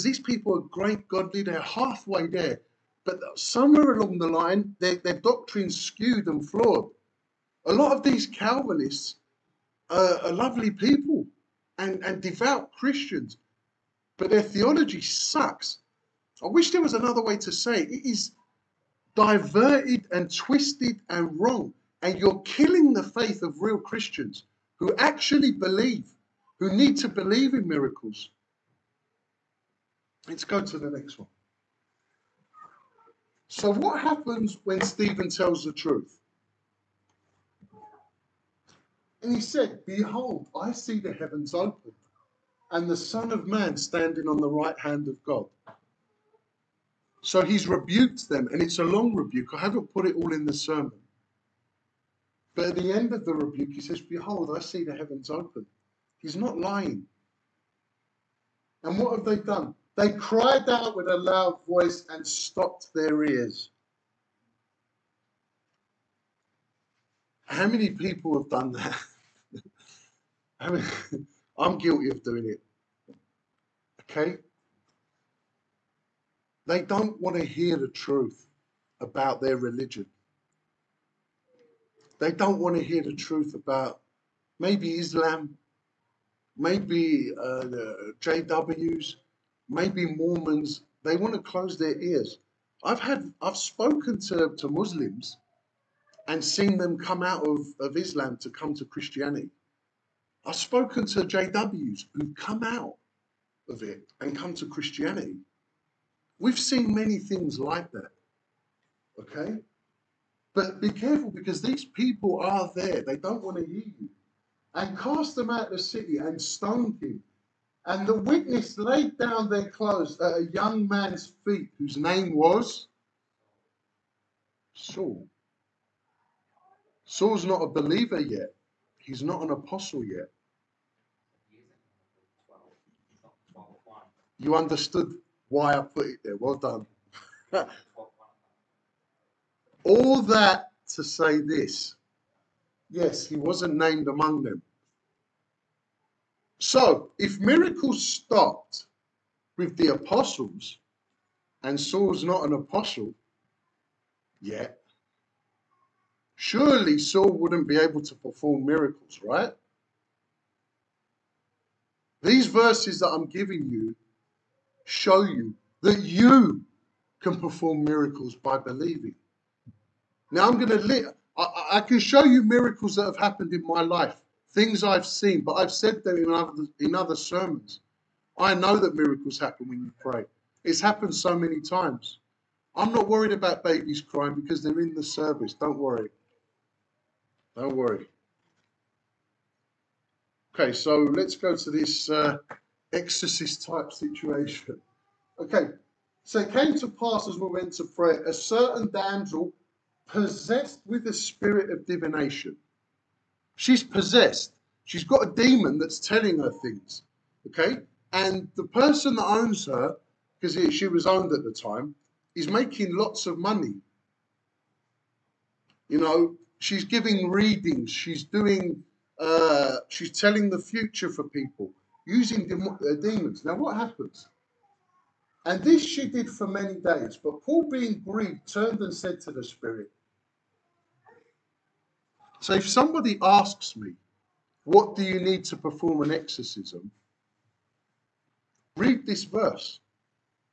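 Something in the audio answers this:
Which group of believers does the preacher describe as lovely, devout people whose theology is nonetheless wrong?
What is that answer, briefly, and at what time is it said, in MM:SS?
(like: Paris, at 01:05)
Calvinists, at 00:08.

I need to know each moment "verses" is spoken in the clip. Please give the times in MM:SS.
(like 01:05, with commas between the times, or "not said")
02:42, 03:59.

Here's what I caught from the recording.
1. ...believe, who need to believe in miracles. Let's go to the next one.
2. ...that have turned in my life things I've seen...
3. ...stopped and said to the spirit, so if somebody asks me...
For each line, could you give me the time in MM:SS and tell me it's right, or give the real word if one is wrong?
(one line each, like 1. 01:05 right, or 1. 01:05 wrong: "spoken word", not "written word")
1. 00:25 right
2. 02:52 wrong: "happened", not "turned"
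3. 03:48 wrong: "turned", not "stopped".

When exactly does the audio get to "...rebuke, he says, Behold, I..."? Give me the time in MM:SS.
00:53.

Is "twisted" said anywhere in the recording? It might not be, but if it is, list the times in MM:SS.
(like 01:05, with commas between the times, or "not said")
00:20.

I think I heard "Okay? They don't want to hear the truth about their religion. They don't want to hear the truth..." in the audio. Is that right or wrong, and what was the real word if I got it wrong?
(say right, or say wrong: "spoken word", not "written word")
right.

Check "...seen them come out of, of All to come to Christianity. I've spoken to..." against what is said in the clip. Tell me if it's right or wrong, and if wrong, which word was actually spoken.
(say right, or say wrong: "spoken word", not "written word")
wrong: "Islam", not "All".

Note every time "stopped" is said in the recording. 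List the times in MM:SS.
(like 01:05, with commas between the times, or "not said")
01:02, 02:28.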